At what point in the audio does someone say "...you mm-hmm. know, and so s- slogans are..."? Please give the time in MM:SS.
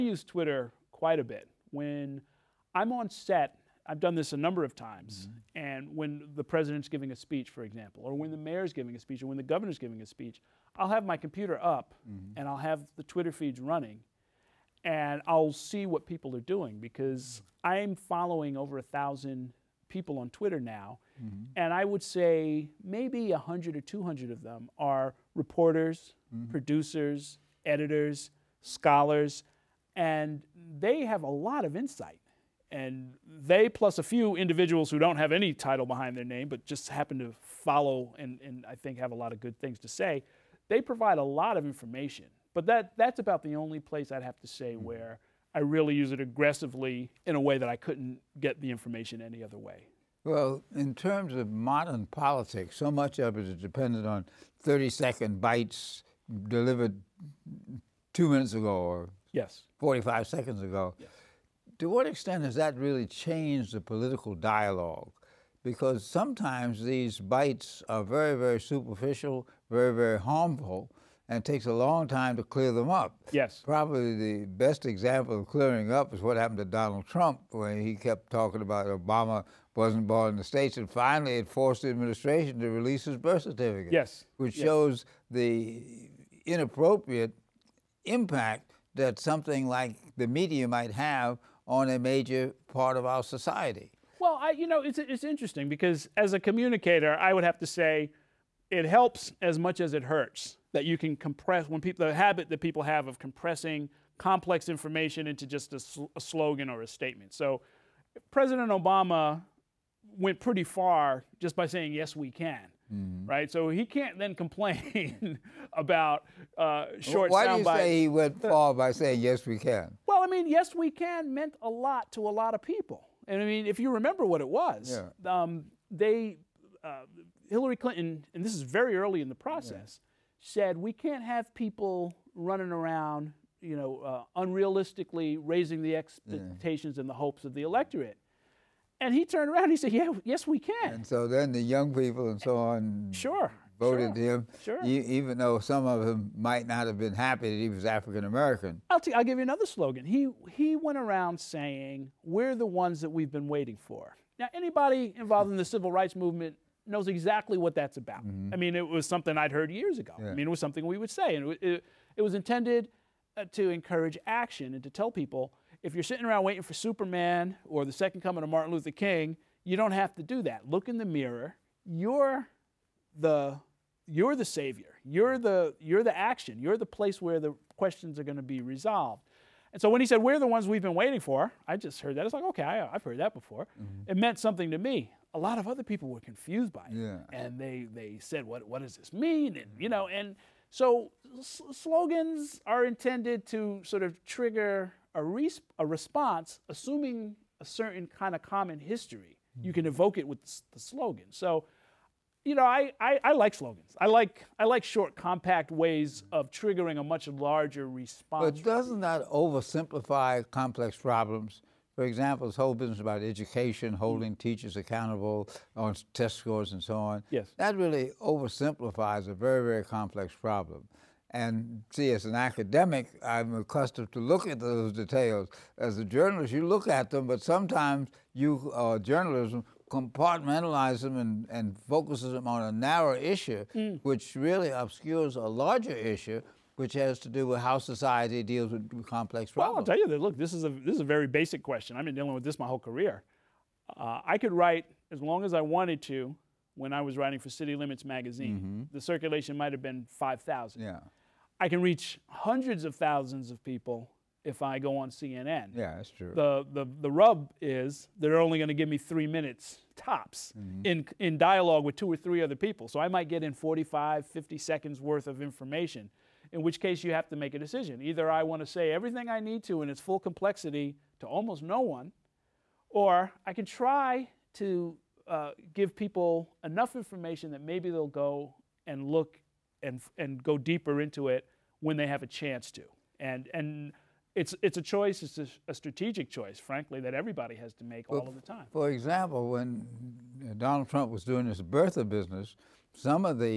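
03:09.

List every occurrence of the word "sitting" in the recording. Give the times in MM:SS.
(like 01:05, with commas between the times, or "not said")
02:46.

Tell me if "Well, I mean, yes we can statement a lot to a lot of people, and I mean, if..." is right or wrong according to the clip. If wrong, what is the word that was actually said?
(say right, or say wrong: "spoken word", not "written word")
wrong: "meant", not "statement".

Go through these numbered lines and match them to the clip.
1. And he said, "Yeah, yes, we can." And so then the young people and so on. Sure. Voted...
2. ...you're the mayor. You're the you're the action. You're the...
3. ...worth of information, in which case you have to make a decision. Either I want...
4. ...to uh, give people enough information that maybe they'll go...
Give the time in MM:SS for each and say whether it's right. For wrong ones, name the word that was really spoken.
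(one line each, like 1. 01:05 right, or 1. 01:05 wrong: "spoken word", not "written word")
1. 02:19 right
2. 02:54 wrong: "savior", not "mayor"
3. 04:24 right
4. 04:34 right.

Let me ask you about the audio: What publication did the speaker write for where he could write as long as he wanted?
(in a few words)
City Limits magazine.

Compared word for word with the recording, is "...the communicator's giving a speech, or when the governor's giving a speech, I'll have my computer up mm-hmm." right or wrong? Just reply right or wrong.
wrong.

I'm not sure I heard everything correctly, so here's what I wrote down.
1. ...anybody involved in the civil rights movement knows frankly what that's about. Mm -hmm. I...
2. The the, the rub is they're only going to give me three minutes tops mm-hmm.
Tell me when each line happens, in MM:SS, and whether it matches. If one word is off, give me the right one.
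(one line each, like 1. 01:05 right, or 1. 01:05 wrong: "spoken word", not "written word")
1. 02:34 wrong: "exactly", not "frankly"
2. 04:16 right.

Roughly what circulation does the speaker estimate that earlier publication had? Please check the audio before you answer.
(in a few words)
5000.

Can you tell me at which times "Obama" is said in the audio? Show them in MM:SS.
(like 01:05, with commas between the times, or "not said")
01:18, 01:48.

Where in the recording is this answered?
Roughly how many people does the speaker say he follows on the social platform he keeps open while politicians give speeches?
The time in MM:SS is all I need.
00:18.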